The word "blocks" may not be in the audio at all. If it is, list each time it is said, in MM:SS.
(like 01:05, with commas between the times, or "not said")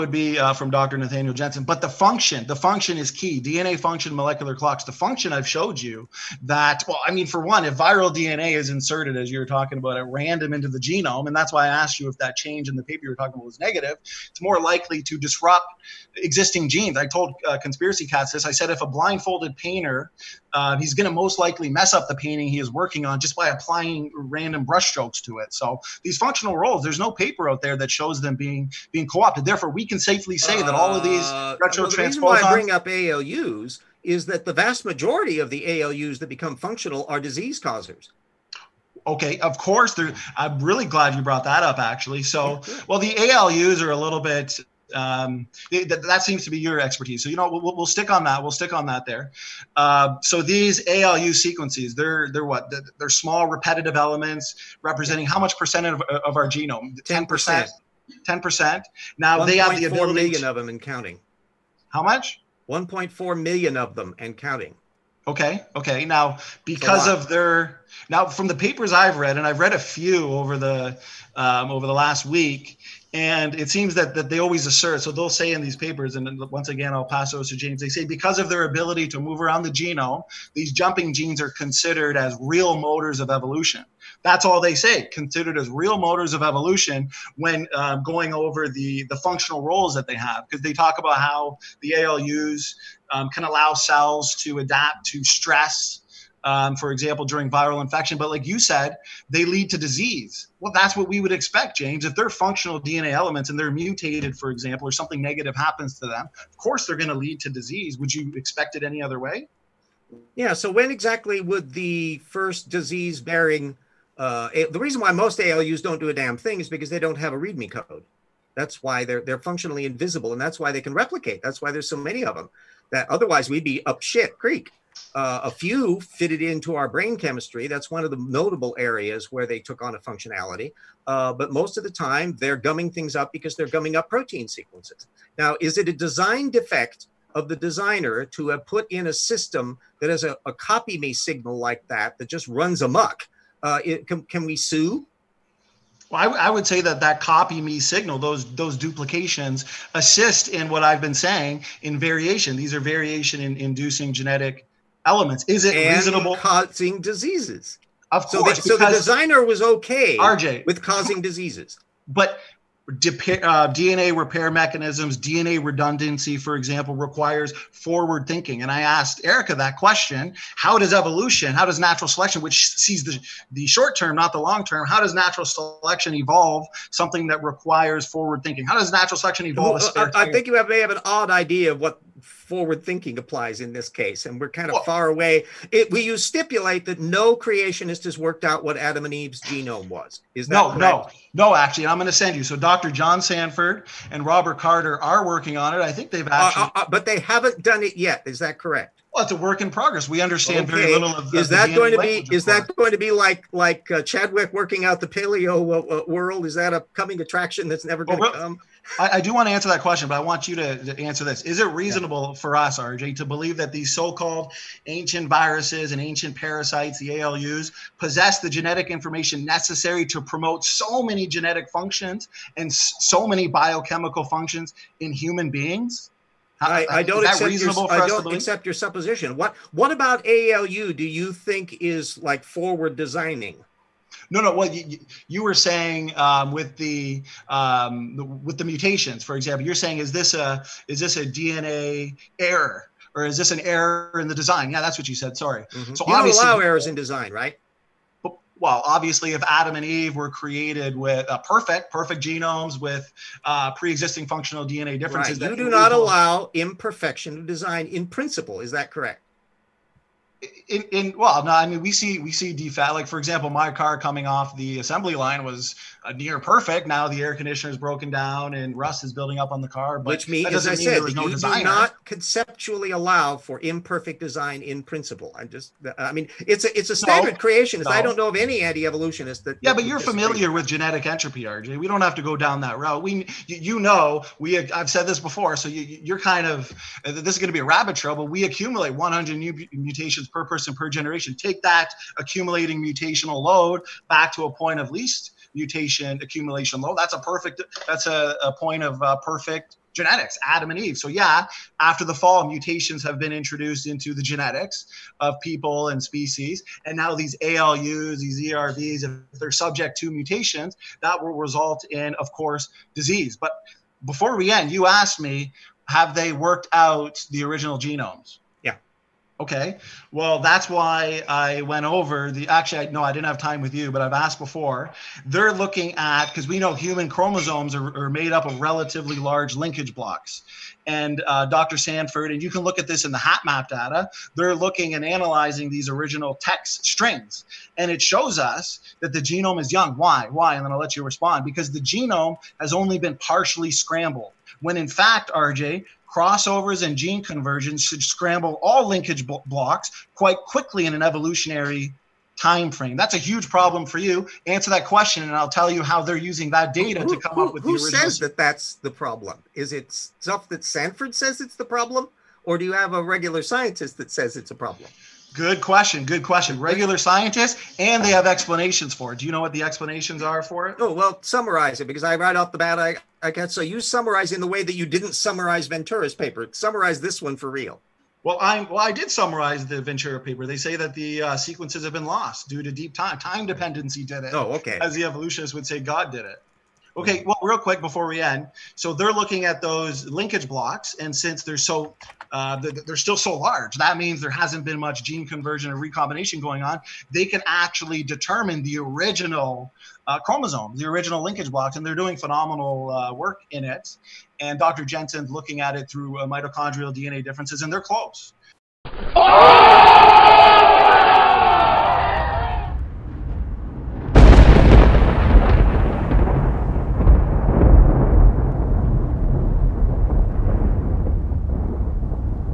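05:29, 05:49, 06:30, 06:41.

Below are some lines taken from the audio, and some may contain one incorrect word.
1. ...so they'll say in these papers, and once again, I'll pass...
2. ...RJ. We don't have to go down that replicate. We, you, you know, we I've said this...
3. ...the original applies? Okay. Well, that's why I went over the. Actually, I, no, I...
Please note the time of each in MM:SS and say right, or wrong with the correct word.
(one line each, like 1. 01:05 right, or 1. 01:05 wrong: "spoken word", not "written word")
1. 01:15 right
2. 04:41 wrong: "route", not "replicate"
3. 05:17 wrong: "genomes", not "applies".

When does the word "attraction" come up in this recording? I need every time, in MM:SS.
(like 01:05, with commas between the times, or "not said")
03:27.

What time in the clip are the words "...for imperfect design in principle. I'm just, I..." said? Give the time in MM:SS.
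04:33.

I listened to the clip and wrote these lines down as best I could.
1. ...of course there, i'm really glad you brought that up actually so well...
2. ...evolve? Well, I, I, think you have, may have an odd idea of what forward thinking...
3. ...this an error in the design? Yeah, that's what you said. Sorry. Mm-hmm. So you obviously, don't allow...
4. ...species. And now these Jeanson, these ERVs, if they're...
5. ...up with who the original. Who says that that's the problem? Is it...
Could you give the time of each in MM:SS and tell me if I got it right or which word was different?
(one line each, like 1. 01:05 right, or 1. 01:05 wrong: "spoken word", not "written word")
1. 00:39 right
2. 02:59 right
3. 04:03 right
4. 05:06 wrong: "ALUs", not "Jeanson"
5. 05:57 right.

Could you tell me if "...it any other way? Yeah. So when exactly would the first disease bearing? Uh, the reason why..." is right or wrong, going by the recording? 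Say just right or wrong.
right.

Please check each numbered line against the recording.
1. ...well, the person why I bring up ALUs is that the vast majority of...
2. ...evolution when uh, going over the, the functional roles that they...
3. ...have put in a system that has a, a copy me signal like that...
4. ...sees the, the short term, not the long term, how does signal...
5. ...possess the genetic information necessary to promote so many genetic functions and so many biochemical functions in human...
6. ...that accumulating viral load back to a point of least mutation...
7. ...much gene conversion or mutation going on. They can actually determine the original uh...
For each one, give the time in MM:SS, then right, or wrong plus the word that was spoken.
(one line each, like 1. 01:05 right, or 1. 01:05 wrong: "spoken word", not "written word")
1. 00:31 wrong: "reason", not "person"
2. 01:26 right
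3. 02:18 right
4. 02:52 wrong: "natural", not "signal"
5. 03:37 right
6. 04:51 wrong: "mutational", not "viral"
7. 06:34 wrong: "recombination", not "mutation".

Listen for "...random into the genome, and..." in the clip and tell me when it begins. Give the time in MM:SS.
00:10.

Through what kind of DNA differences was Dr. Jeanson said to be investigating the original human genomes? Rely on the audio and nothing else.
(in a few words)
mitochondrial DNA.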